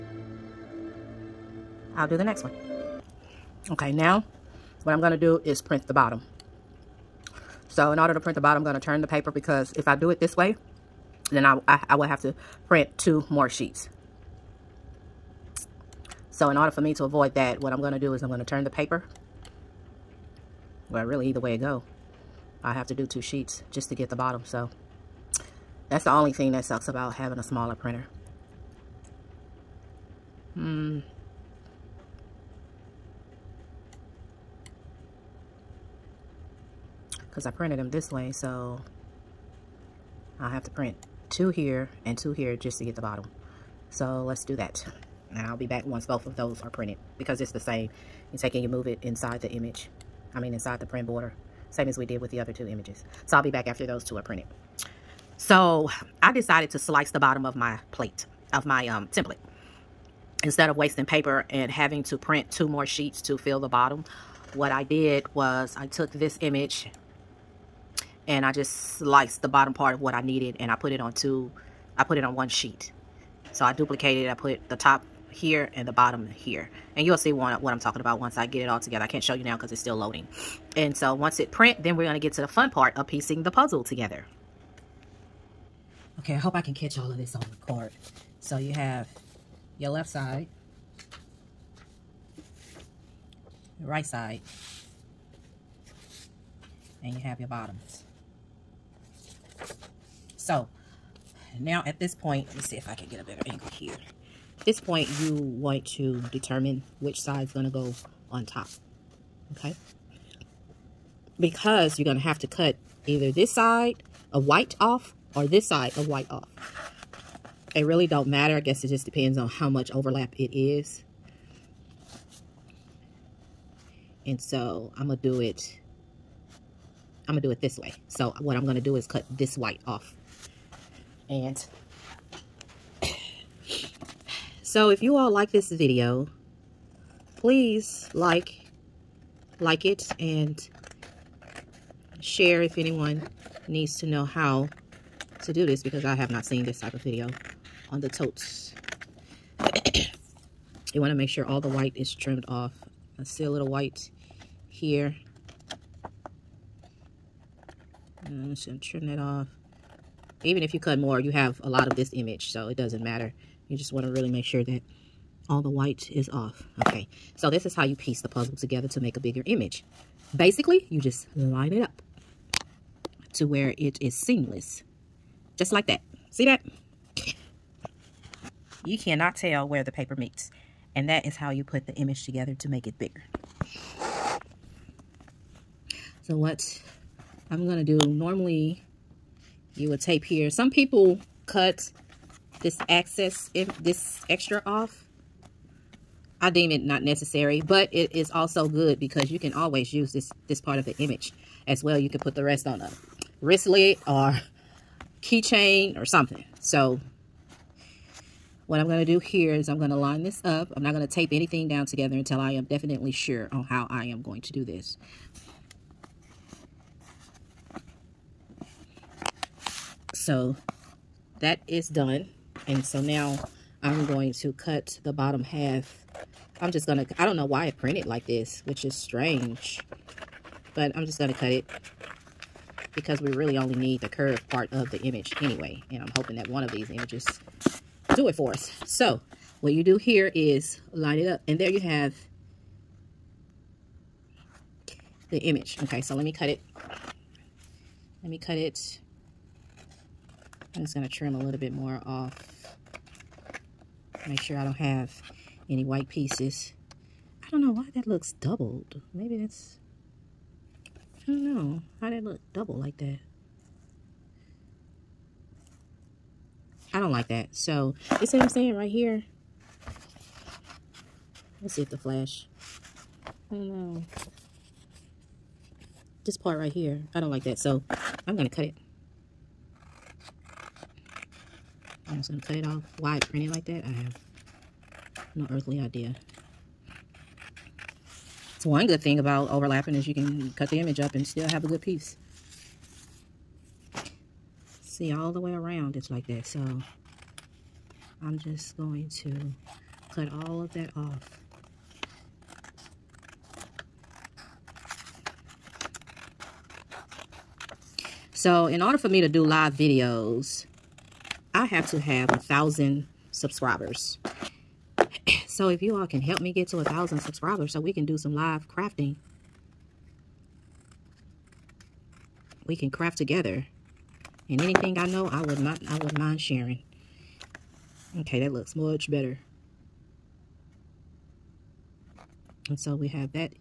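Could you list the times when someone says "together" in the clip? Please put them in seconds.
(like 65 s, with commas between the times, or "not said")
78 s, 83 s, 168 s, 182 s, 211 s, 323 s.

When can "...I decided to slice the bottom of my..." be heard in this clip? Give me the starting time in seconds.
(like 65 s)
56 s.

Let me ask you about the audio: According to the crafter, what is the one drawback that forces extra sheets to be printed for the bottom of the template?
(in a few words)
a smaller printer.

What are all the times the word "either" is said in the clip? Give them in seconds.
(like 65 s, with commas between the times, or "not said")
21 s, 113 s.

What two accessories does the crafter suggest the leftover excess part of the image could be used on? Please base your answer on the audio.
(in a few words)
wristlet or keychain.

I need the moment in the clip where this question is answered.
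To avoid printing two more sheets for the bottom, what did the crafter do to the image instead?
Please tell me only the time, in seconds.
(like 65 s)
68 s.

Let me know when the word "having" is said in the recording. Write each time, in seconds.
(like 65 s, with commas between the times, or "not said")
27 s, 61 s.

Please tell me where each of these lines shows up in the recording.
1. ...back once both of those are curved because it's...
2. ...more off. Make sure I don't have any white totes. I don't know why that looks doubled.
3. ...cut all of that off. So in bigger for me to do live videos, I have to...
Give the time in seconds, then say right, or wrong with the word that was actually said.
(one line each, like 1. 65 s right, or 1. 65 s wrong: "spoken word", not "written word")
1. 45 s wrong: "printed", not "curved"
2. 251 s wrong: "pieces", not "totes"
3. 300 s wrong: "order", not "bigger".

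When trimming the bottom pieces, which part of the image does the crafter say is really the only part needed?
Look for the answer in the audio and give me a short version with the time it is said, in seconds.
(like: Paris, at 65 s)
the curved part, at 234 s.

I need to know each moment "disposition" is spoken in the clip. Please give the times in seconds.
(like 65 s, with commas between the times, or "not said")
not said.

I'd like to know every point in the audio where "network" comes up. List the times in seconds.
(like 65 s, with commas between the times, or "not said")
not said.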